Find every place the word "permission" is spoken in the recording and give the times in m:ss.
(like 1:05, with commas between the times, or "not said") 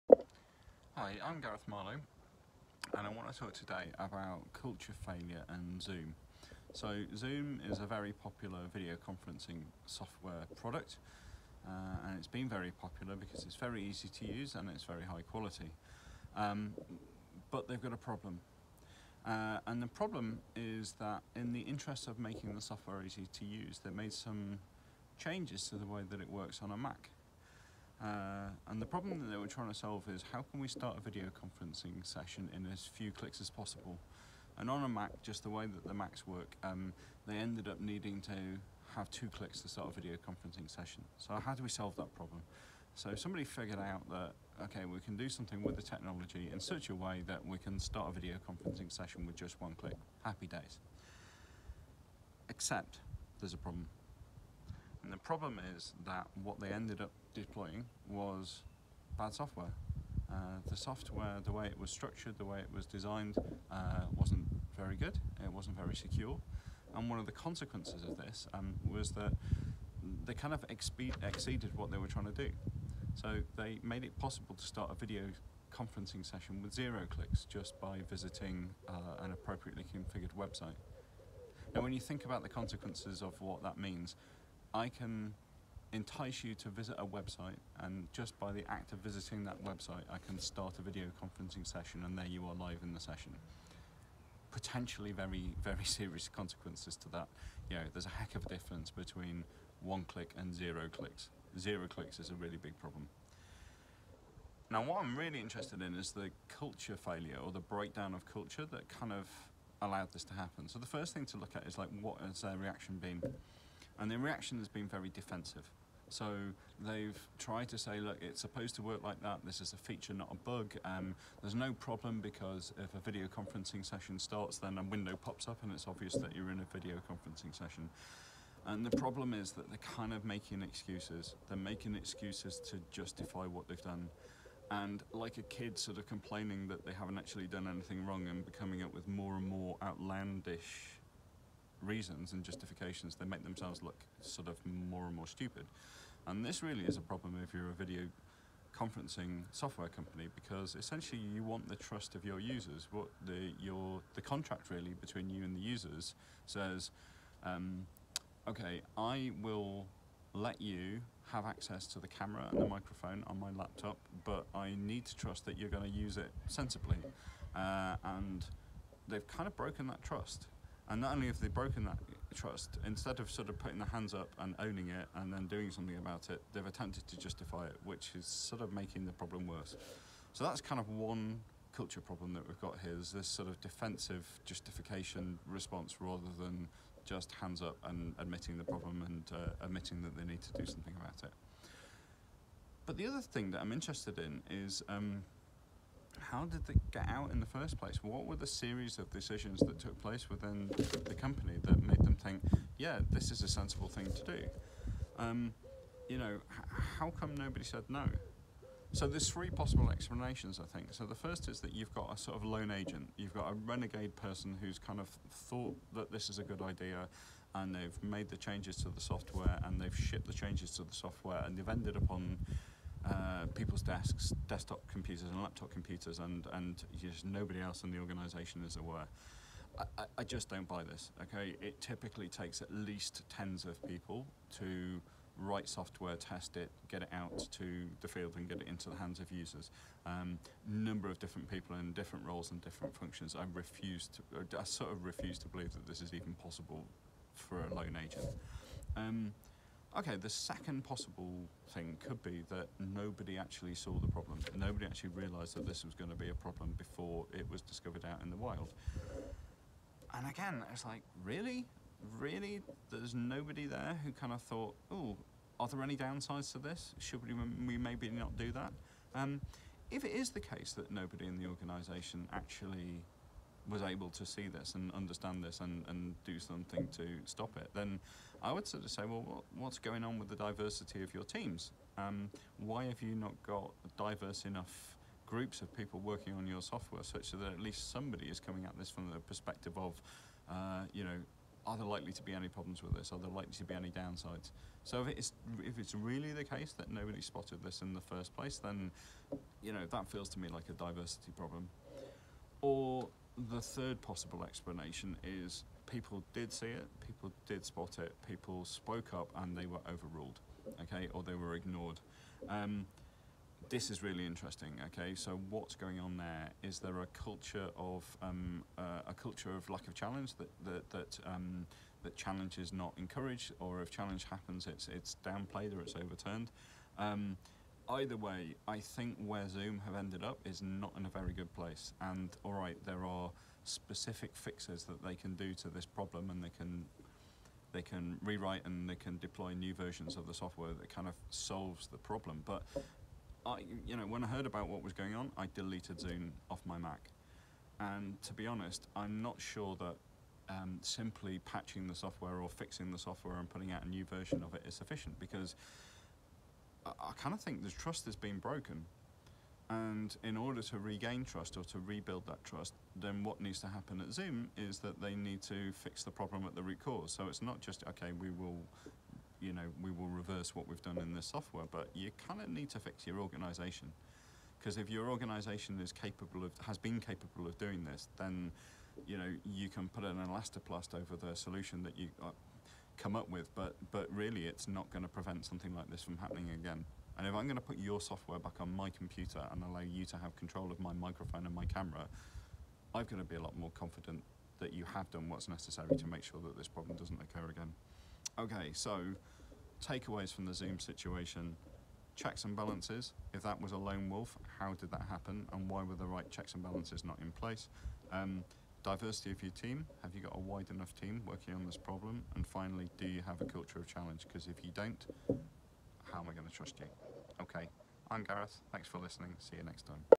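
not said.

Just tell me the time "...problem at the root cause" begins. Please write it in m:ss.
6:06.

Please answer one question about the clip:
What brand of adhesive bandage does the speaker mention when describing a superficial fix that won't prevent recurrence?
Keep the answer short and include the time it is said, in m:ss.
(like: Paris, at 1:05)
Elastoplast, at 6:20.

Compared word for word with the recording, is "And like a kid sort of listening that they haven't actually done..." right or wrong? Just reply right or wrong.
wrong.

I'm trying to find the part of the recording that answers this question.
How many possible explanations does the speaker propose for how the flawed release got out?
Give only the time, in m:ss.
3:29.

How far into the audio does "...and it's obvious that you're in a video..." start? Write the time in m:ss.
2:05.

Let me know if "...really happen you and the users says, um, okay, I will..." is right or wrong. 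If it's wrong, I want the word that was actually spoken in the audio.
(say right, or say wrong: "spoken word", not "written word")
wrong: "between", not "happen".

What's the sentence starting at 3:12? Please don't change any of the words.
But the other thing that I'm interested in is.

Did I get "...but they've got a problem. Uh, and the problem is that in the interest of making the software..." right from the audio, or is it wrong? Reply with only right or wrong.
right.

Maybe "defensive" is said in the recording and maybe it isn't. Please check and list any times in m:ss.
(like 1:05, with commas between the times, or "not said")
1:55, 3:03.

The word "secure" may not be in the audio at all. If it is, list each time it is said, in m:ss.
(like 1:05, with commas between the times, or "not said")
1:05.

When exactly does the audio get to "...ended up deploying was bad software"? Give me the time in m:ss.
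0:56.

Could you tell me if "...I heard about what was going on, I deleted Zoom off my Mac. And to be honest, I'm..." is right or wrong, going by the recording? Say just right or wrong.
right.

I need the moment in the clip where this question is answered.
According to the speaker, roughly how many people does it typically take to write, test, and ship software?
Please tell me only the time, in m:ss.
3:53.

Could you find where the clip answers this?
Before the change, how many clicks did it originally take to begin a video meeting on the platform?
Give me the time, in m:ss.
0:39.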